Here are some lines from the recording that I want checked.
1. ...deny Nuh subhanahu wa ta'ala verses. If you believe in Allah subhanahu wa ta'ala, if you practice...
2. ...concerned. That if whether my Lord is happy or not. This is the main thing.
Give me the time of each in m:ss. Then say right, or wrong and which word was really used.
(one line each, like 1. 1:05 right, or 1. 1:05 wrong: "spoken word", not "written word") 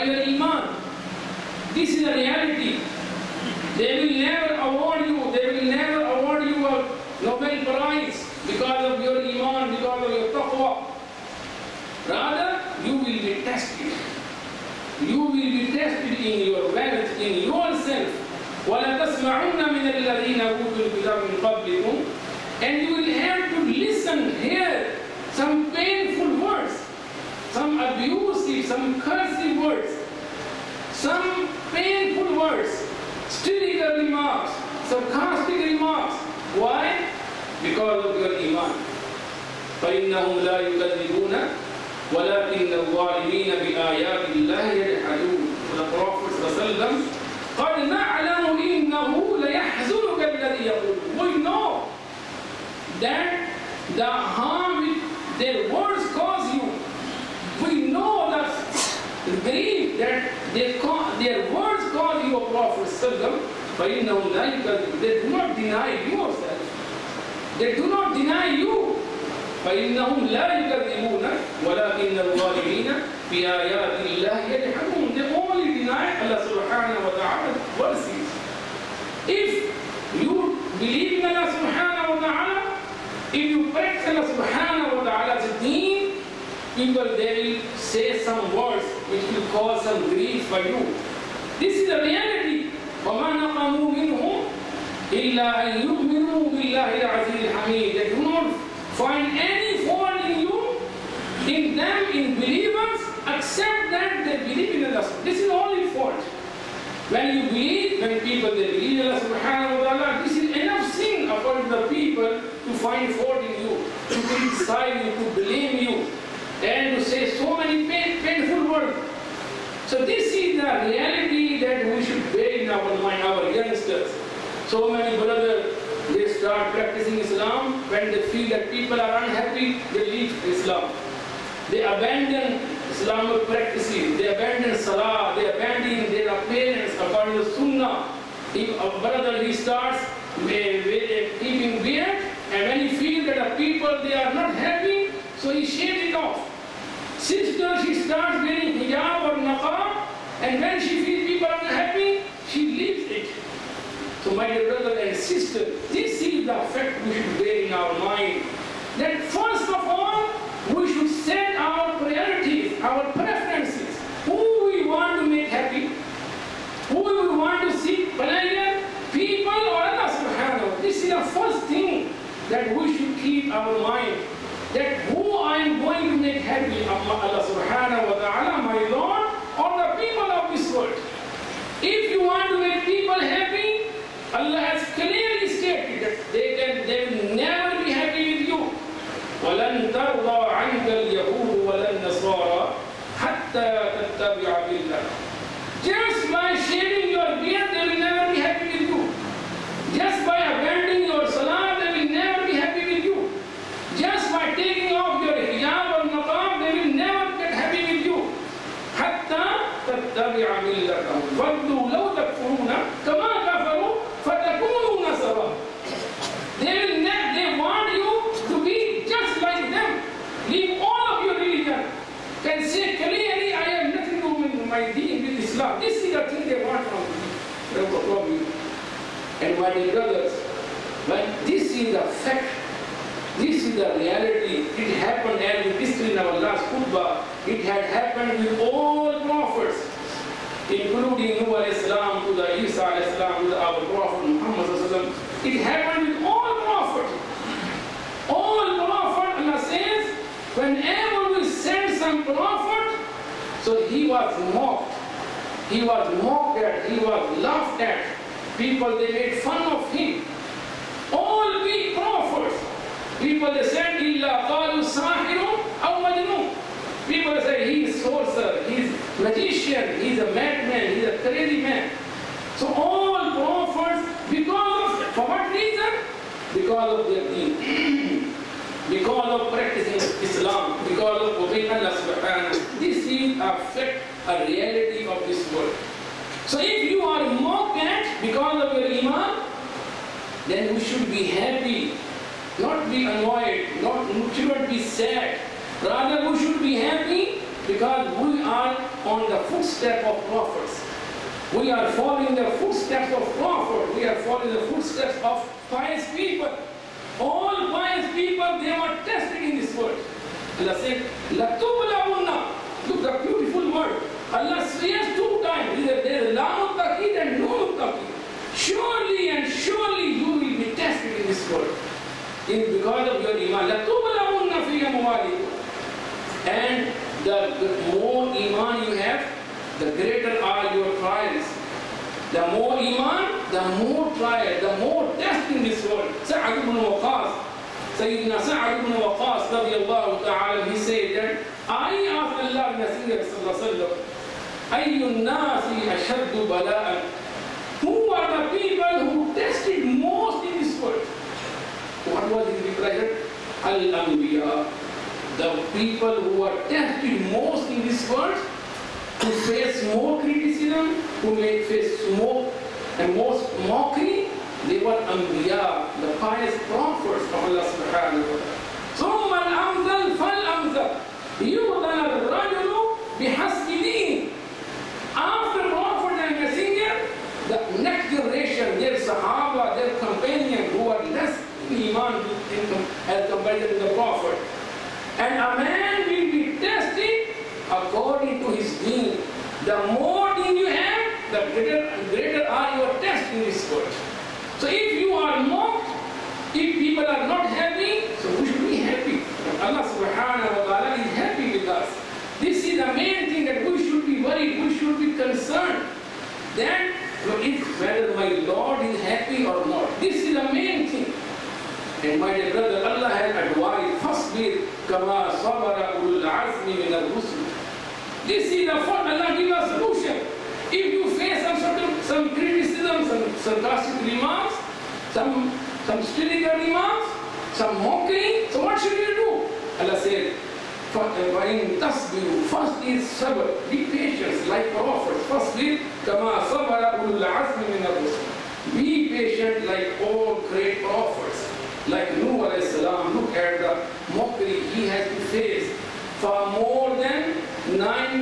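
1. 1:15 wrong: "Allah", not "Nuh"
2. 6:45 right.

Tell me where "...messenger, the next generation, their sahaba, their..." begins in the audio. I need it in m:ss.
6:16.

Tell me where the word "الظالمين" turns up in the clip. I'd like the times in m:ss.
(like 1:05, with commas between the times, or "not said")
0:42, 1:12.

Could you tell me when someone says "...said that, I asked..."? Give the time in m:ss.
5:40.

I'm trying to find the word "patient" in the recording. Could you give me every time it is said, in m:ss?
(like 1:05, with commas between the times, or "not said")
7:13, 7:19.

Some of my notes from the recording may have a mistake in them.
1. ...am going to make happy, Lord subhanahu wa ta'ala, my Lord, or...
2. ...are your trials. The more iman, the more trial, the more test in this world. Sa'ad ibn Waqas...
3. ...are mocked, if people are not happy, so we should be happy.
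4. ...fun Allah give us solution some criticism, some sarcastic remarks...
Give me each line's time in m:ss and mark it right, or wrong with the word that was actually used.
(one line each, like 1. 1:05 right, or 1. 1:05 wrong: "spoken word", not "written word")
1. 2:55 wrong: "Allah", not "Lord"
2. 5:30 right
3. 6:35 right
4. 6:58 right.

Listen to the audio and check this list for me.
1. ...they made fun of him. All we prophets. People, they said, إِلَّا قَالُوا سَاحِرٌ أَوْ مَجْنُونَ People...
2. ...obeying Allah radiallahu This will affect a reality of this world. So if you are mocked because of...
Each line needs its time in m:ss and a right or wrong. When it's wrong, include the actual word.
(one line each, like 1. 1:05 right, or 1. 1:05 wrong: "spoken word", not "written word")
1. 4:18 right
2. 4:41 wrong: "subhanahu", not "radiallahu".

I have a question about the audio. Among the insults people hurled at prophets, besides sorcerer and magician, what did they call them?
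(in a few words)
A madman.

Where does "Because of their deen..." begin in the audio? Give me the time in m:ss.
4:36.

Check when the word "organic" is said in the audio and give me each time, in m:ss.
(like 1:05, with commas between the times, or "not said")
not said.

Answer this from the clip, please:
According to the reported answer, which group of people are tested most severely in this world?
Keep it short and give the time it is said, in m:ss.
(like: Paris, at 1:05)
Al-Anbiya, at 5:53.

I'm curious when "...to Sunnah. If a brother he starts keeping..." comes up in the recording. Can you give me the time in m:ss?
2:17.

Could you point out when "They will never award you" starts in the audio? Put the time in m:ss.
0:03.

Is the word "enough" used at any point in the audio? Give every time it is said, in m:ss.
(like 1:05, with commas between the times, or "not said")
1:50.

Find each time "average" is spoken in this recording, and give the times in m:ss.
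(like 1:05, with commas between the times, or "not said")
not said.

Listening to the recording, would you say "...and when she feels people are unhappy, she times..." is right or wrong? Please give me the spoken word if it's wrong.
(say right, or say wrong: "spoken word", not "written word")
wrong: "leaves", not "times".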